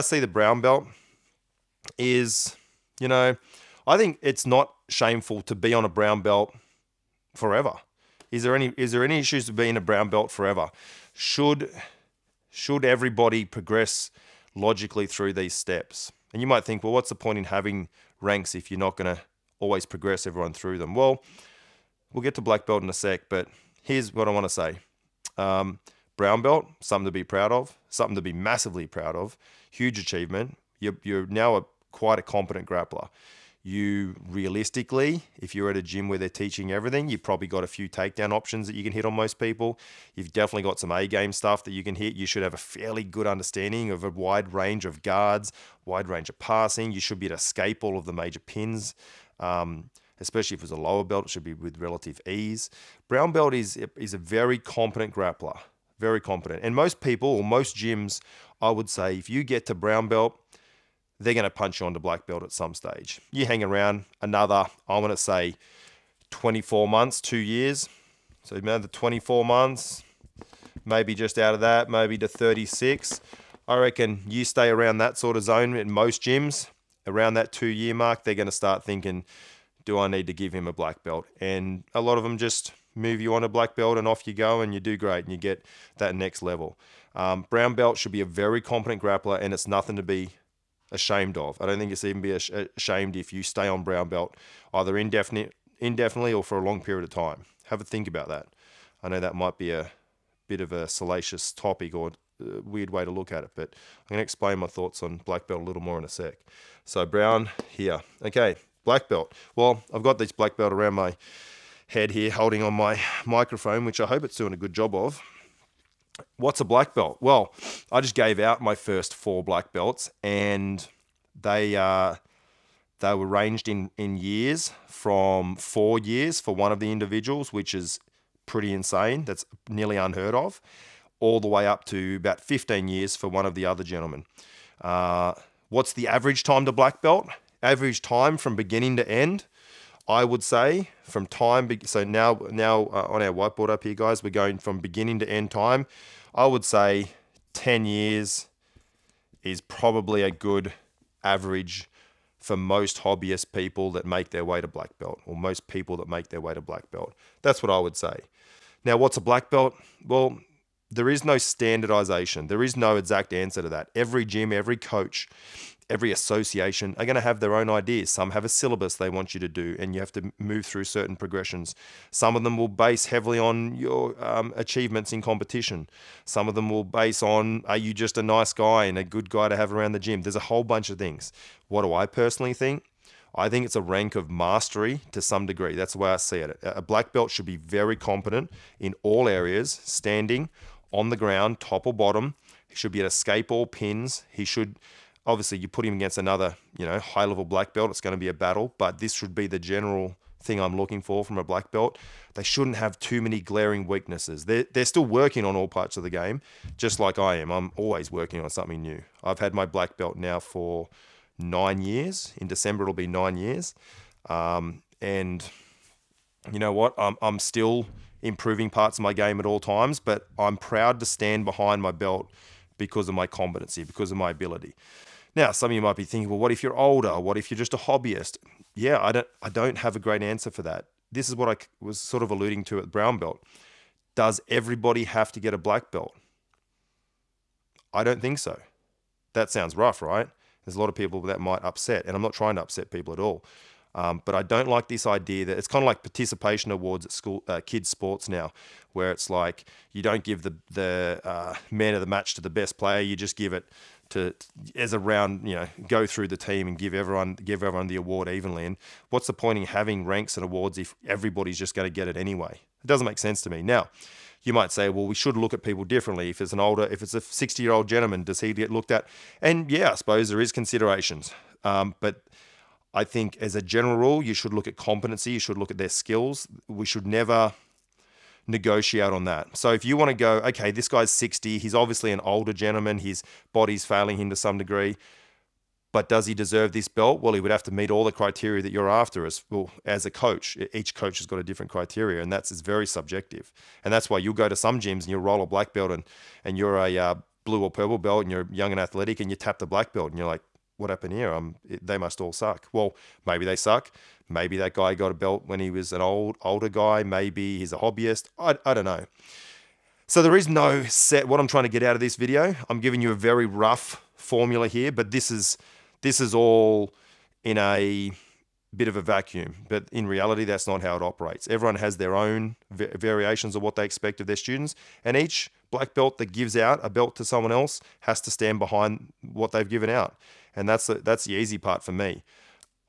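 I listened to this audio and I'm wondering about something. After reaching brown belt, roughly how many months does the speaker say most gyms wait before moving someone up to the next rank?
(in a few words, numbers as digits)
24 months.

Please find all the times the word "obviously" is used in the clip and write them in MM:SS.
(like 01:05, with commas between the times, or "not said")
03:15, 04:41.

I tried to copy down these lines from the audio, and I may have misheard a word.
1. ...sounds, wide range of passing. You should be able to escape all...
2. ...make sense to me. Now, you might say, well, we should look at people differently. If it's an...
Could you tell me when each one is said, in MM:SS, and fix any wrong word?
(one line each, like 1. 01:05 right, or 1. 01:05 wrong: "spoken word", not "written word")
1. 00:45 wrong: "guards", not "sounds"
2. 04:23 right.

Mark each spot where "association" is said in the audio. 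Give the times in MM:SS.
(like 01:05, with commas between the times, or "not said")
02:46.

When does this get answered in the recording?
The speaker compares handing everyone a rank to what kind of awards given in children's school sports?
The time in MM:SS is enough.
04:06.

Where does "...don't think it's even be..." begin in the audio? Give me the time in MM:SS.
01:31.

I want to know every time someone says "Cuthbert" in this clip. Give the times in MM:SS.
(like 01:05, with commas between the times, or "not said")
not said.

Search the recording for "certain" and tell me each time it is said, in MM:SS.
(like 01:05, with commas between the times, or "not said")
02:50.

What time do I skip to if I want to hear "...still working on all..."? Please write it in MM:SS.
03:24.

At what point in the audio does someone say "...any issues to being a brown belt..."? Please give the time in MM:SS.
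00:09.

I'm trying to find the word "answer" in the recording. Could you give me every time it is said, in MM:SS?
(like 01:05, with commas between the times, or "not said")
02:43, 03:50.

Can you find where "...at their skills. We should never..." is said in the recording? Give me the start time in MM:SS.
04:35.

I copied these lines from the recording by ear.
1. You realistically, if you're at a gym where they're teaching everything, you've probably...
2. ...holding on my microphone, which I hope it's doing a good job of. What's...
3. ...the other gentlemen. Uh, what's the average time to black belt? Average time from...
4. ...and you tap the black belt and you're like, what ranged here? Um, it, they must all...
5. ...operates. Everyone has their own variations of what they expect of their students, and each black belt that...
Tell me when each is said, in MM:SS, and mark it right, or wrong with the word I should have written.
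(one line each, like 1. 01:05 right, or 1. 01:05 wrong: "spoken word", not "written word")
1. 00:33 right
2. 01:52 right
3. 02:13 right
4. 04:59 wrong: "happened", not "ranged"
5. 05:21 right.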